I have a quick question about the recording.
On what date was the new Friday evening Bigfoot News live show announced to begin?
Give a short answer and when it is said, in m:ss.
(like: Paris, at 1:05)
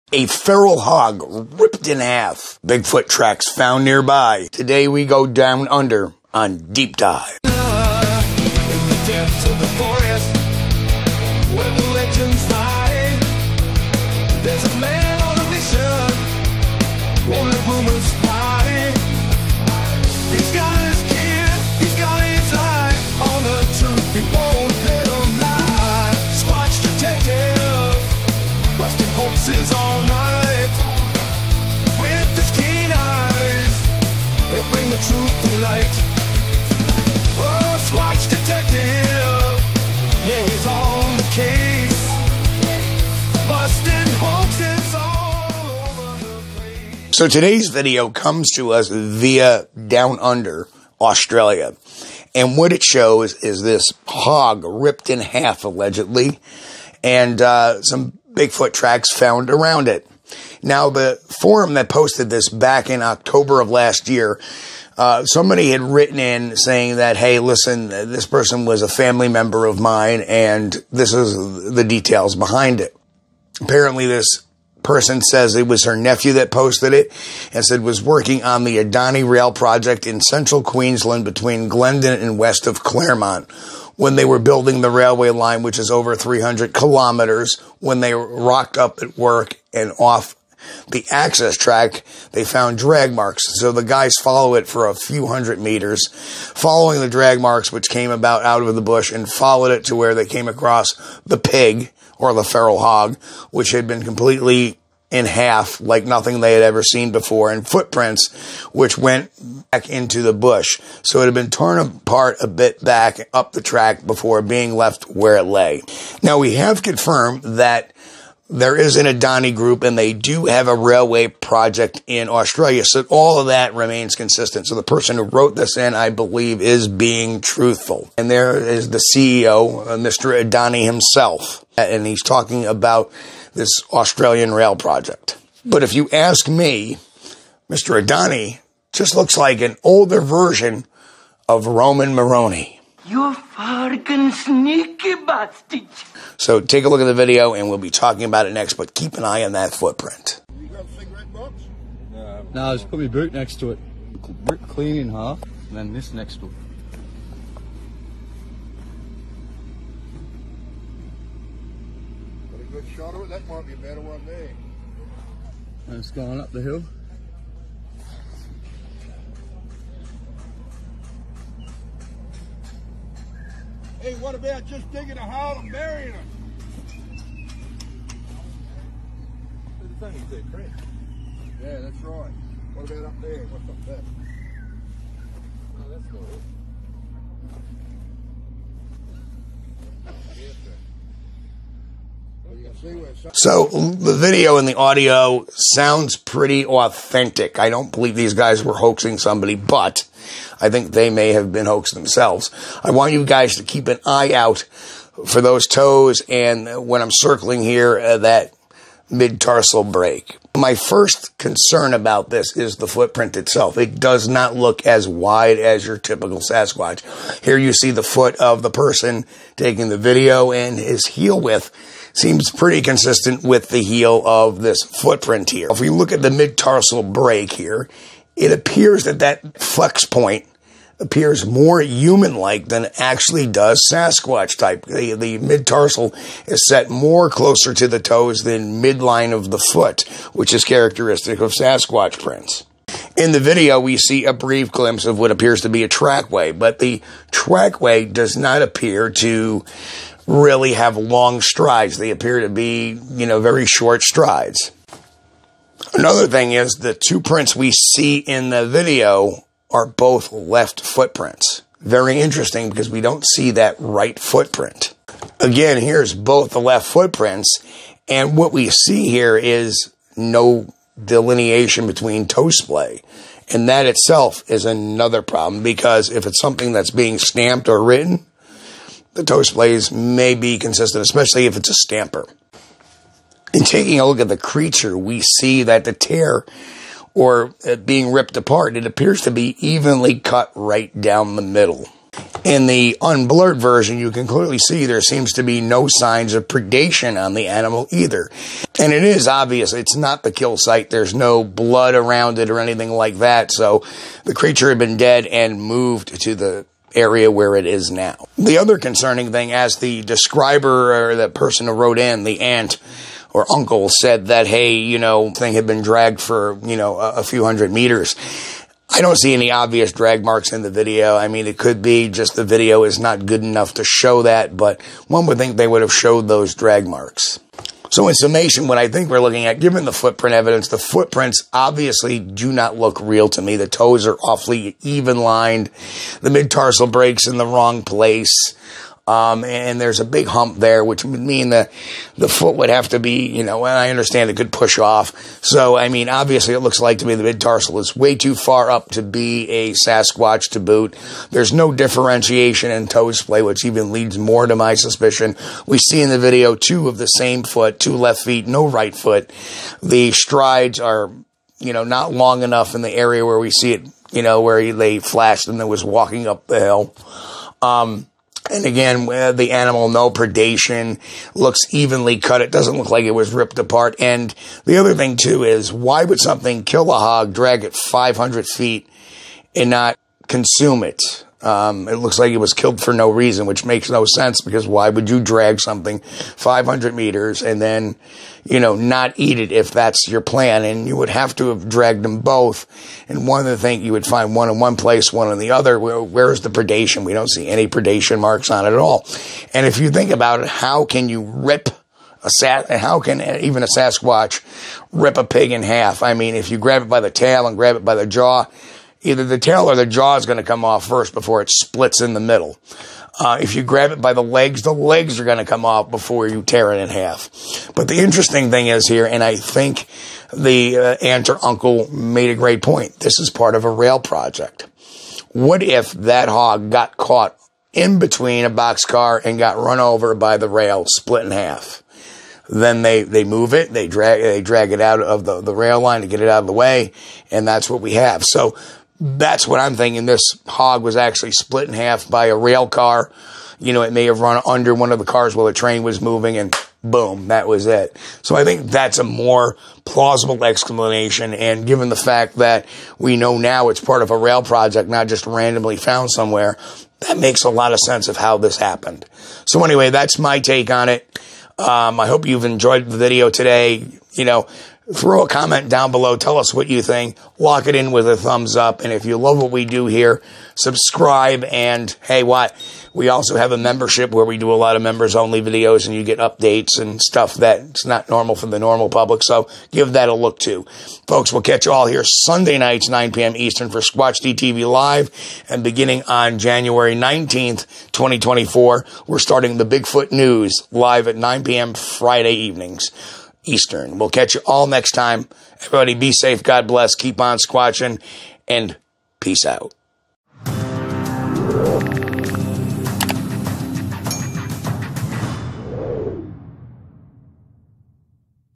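January 19, 2024, at 8:06.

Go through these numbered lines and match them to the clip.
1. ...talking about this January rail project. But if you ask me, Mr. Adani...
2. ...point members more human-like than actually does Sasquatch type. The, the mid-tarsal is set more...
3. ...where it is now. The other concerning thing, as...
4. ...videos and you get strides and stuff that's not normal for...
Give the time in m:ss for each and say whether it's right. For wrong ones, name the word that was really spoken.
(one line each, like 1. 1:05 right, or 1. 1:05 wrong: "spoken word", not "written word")
1. 2:12 wrong: "Australian", not "January"
2. 3:50 wrong: "appears", not "members"
3. 5:07 right
4. 7:55 wrong: "updates", not "strides".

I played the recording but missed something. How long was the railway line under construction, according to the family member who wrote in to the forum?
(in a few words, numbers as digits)
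Over 300 kilometers.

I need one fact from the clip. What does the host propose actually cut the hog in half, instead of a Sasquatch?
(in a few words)
A rail car.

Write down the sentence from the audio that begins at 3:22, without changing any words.
I want you guys to keep an eye out for those toes and when I'm circling here, uh, that mid tarsal break.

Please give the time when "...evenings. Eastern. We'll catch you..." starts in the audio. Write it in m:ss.
8:12.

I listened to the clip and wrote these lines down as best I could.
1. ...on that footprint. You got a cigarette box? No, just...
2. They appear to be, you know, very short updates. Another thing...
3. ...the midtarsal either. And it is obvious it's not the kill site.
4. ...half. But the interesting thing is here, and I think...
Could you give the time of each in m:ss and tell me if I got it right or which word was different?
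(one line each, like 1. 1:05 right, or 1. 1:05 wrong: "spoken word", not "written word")
1. 2:29 right
2. 4:11 wrong: "strides", not "updates"
3. 4:57 wrong: "animal", not "midtarsal"
4. 6:56 right.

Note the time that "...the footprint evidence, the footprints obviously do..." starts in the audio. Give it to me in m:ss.
5:29.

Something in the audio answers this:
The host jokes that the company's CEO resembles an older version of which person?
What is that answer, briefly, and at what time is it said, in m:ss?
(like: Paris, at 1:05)
Roman Moroni, at 2:21.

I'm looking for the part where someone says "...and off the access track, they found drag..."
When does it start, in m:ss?
1:29.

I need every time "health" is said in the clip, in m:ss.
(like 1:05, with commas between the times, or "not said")
not said.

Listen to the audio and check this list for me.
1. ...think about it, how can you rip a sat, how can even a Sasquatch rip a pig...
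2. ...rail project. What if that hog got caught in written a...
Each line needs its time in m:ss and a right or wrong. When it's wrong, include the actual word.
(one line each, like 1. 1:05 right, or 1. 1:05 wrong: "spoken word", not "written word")
1. 6:39 right
2. 7:03 wrong: "between", not "written".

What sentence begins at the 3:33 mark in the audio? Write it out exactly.
It does not look as wide as your typical Sasquatch.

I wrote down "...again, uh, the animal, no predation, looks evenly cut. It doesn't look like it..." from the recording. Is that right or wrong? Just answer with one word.
right.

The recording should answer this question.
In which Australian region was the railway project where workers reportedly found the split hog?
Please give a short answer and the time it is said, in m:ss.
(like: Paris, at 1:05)
Central Queensland, at 1:20.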